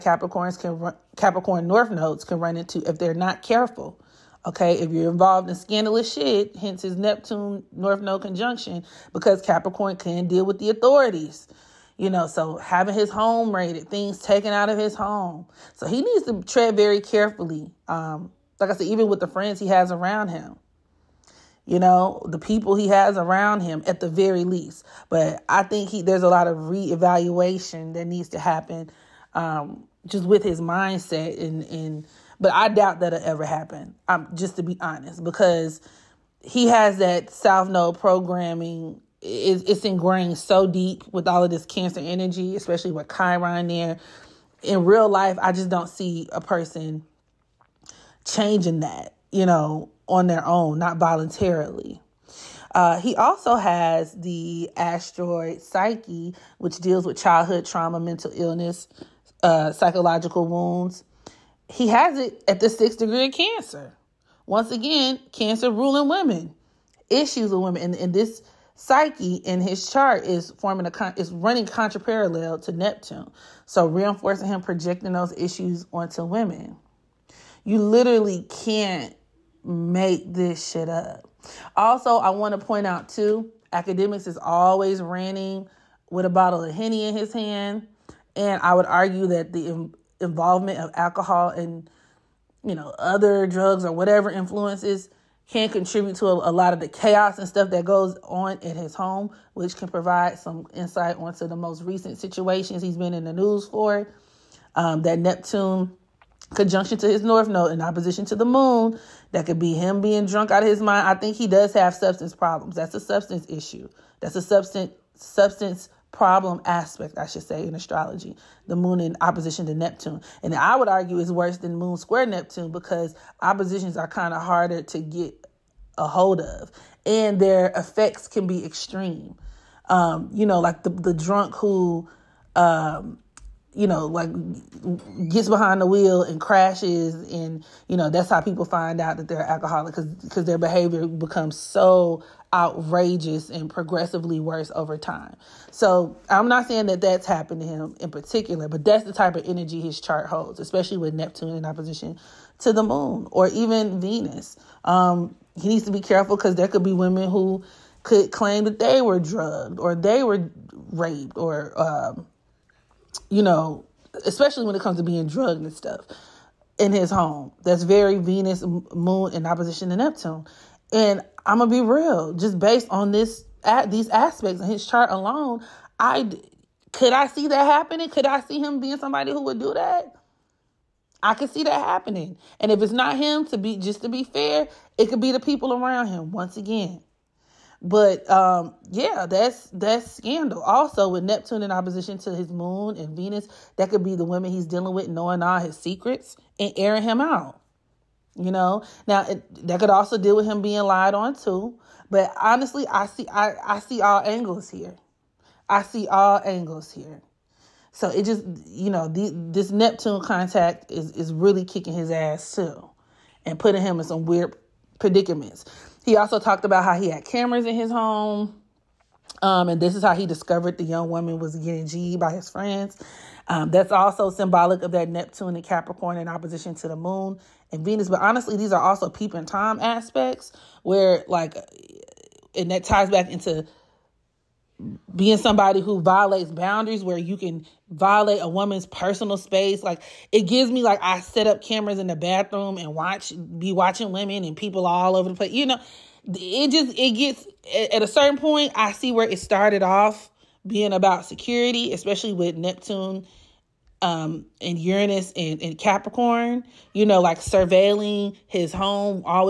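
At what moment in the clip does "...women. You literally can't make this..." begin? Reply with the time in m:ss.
1:16.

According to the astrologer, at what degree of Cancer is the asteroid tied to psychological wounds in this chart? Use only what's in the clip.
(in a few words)
6th degree.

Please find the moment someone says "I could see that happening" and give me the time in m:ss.
3:01.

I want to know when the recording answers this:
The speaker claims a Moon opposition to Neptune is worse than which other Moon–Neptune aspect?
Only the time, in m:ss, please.
2:01.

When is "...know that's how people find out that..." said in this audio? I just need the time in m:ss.
2:17.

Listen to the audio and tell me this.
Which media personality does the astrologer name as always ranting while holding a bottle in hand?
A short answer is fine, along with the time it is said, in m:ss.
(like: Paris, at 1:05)
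Akademiks, at 1:23.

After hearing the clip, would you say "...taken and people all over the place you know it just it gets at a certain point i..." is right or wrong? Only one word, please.
wrong.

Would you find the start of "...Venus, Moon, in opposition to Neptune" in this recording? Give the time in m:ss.
2:48.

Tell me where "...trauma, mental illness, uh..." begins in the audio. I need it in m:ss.
0:57.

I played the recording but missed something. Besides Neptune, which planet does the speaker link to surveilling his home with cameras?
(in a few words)
Uranus.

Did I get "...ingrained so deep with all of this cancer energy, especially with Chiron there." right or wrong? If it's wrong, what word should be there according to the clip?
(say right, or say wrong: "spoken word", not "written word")
right.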